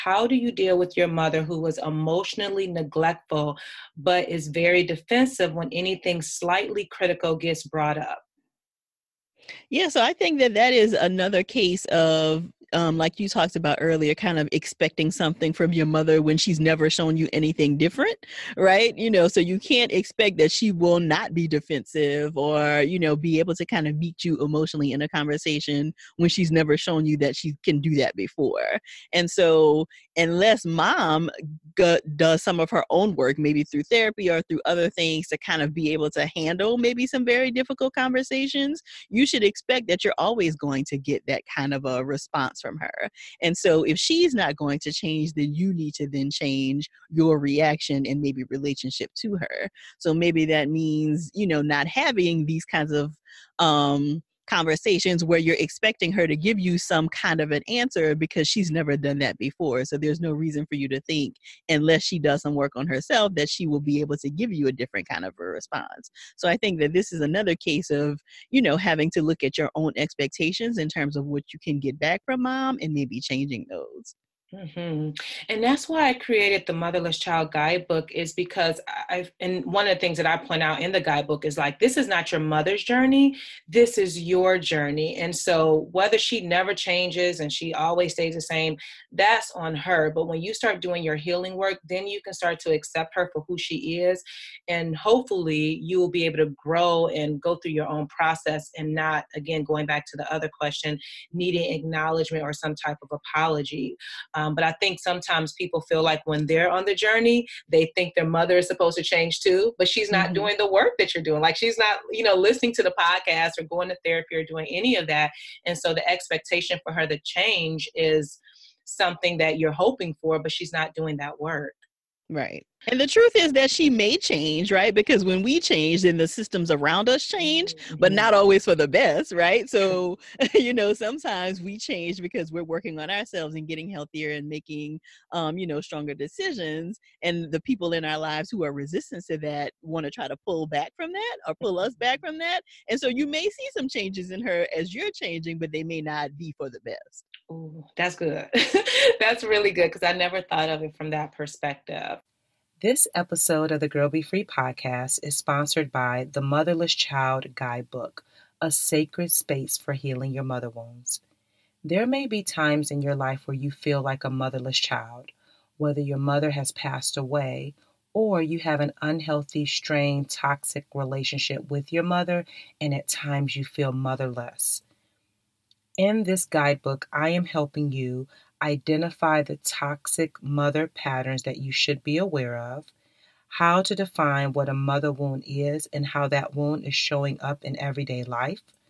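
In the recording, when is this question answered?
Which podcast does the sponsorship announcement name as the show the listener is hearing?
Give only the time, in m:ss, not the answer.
2:33.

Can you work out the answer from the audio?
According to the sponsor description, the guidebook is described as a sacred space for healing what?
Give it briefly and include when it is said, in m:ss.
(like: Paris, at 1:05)
mother wounds, at 2:40.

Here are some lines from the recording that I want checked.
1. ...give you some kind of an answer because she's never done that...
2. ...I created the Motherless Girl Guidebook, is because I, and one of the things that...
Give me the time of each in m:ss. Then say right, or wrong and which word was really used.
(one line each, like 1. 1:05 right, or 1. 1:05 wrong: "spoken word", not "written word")
1. 0:56 right
2. 1:16 wrong: "Child", not "Girl".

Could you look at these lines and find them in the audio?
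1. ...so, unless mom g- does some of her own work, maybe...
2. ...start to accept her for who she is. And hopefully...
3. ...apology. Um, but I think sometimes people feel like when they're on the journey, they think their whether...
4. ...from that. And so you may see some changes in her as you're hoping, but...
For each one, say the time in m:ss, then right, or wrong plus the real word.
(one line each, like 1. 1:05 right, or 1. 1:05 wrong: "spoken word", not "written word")
1. 0:29 right
2. 1:32 right
3. 1:43 wrong: "mother", not "whether"
4. 2:22 wrong: "changing", not "hoping".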